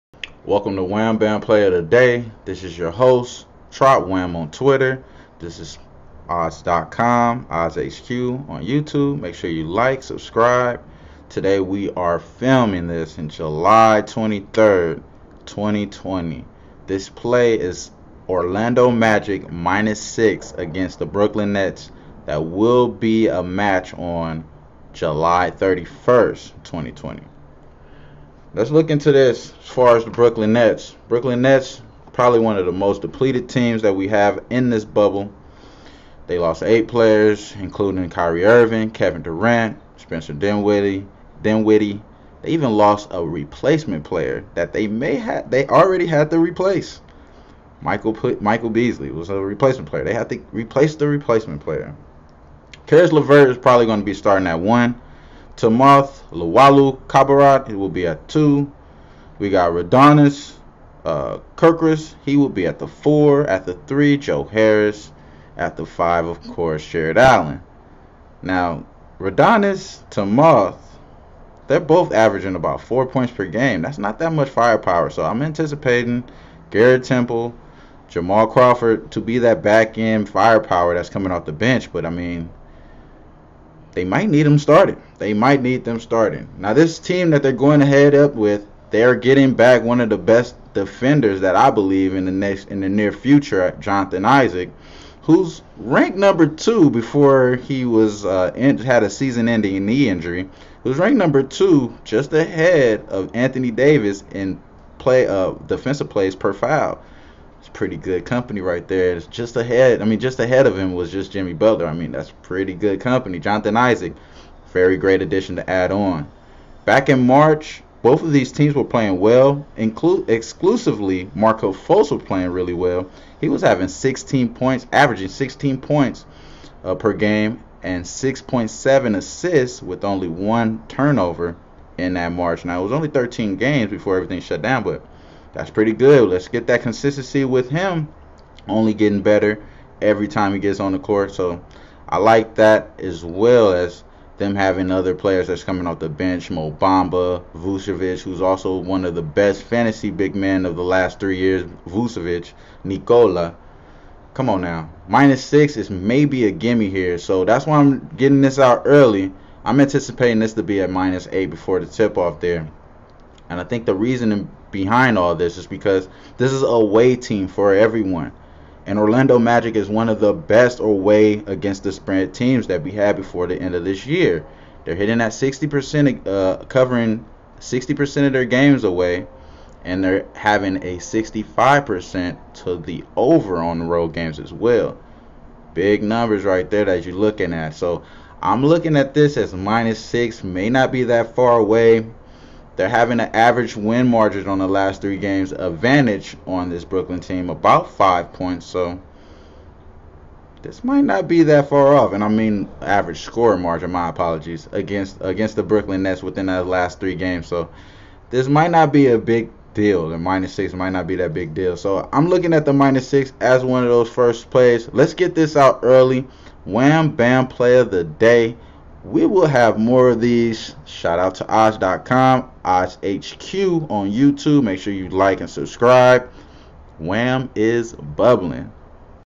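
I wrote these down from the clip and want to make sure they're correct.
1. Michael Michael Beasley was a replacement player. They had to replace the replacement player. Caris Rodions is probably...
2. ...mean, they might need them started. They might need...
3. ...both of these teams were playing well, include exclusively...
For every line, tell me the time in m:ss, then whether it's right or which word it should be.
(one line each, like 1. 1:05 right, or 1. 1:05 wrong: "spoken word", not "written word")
1. 0:47 wrong: "LeVert", not "Rodions"
2. 1:22 right
3. 1:58 right.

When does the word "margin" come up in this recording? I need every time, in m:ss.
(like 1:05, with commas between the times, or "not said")
3:14, 3:23.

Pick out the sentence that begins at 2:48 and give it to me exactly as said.
And Orlando Magic is one of the best away against the spread teams that we had before the end of this year.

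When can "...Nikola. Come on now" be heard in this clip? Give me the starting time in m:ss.
2:32.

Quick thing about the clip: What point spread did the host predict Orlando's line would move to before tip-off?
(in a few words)
-8.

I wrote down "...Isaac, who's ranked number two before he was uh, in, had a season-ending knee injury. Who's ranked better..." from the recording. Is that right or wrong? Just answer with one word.
wrong.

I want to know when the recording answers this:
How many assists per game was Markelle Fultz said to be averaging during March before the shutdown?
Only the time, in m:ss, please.
2:08.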